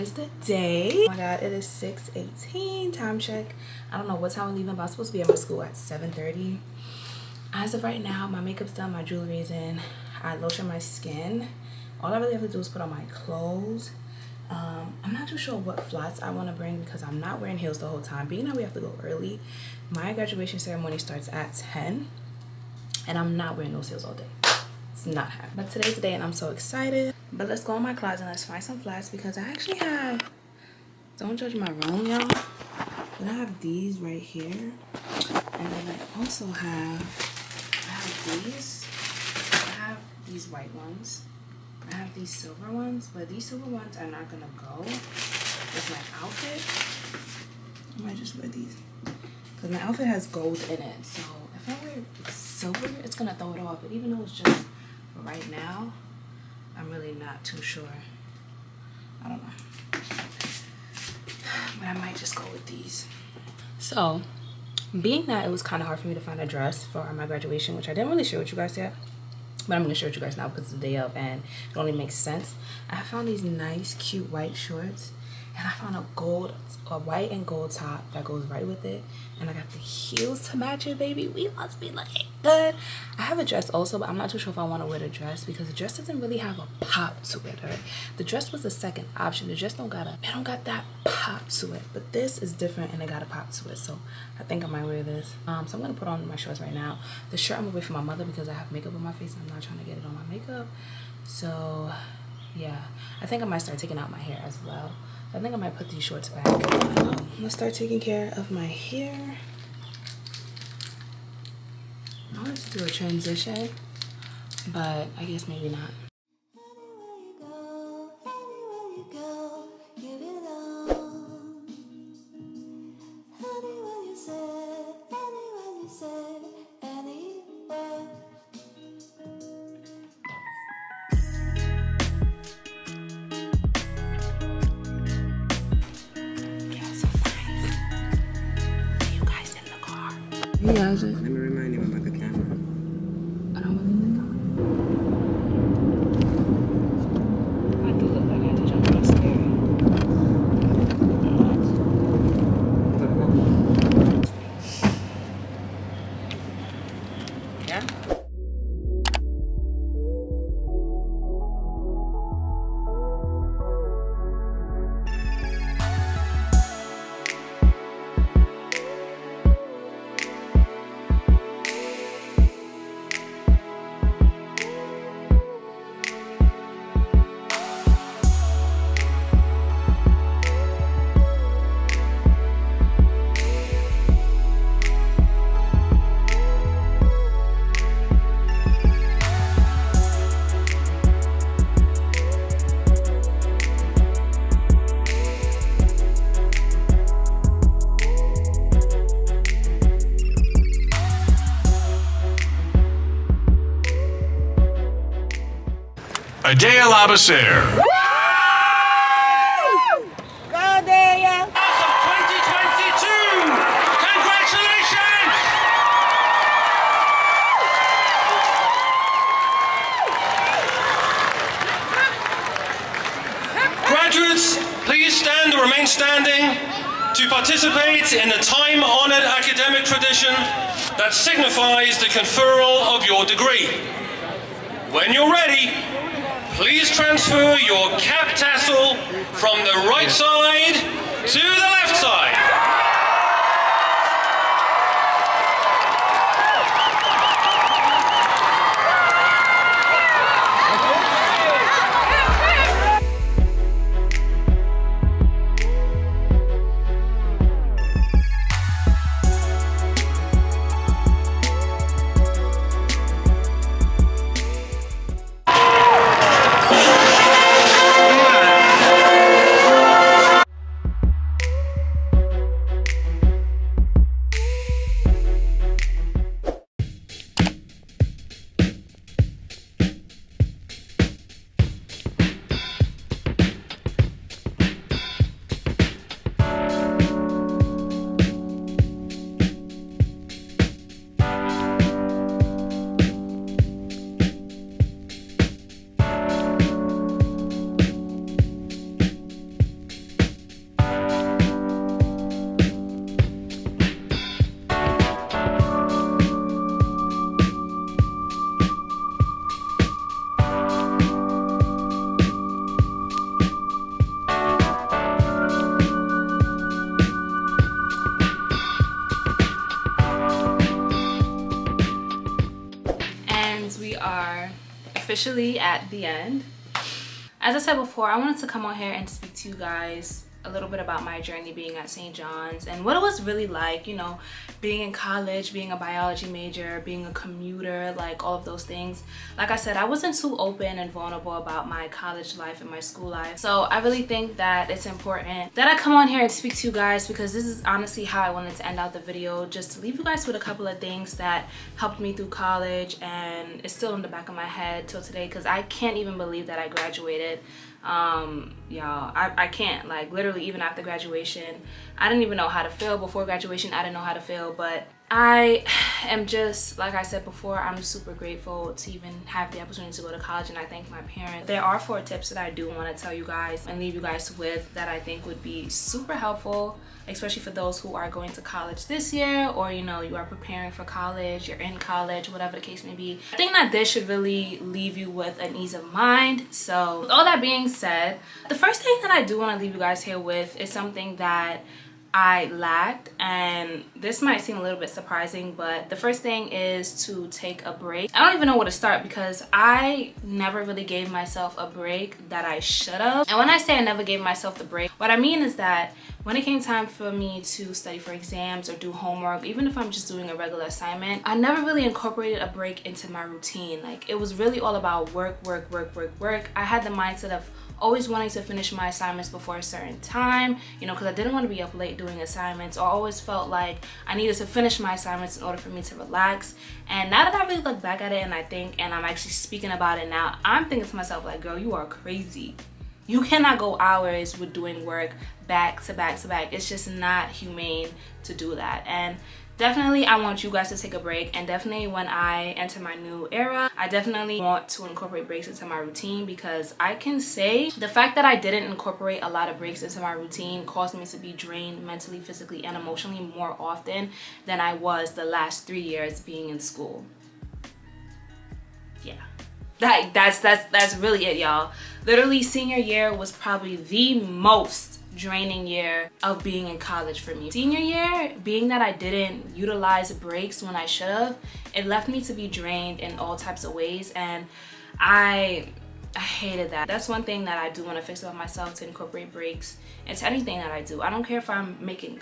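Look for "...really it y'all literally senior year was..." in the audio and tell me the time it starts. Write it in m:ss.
7:40.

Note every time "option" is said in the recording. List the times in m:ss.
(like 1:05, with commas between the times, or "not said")
1:29.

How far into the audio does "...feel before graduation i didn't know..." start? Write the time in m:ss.
6:02.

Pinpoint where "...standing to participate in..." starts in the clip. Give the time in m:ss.
3:45.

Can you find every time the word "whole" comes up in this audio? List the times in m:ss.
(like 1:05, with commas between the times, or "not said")
0:17.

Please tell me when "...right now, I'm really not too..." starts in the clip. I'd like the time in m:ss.
0:55.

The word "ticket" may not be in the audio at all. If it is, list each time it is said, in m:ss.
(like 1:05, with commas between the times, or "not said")
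not said.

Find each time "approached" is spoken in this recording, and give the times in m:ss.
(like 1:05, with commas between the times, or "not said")
not said.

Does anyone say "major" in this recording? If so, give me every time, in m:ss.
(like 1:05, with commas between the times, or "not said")
5:36.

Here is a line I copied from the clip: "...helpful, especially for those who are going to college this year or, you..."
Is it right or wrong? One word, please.
right.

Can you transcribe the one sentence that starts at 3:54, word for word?
When you're ready, Please transfer your cap tassel from the right side to the left side.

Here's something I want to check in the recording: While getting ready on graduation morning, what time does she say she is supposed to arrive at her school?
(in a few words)
7:30.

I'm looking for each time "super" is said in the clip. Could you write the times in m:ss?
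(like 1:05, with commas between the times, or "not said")
6:07, 6:15.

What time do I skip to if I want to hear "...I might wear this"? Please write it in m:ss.
1:34.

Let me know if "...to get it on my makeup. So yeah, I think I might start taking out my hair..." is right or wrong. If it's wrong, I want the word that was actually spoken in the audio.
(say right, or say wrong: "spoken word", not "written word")
right.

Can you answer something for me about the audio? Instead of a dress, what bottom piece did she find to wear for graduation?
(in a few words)
White shorts.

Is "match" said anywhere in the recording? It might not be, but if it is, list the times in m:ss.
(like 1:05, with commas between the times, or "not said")
1:20.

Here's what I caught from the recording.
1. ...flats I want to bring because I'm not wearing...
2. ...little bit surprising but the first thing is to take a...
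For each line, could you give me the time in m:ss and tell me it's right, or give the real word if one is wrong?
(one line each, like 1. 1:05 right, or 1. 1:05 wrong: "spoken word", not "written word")
1. 0:15 right
2. 6:34 right.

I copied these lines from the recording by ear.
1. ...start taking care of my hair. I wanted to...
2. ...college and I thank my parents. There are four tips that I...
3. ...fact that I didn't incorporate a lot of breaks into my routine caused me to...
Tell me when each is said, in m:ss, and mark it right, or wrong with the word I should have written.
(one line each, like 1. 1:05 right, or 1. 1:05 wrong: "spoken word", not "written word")
1. 1:47 right
2. 6:10 right
3. 7:27 right.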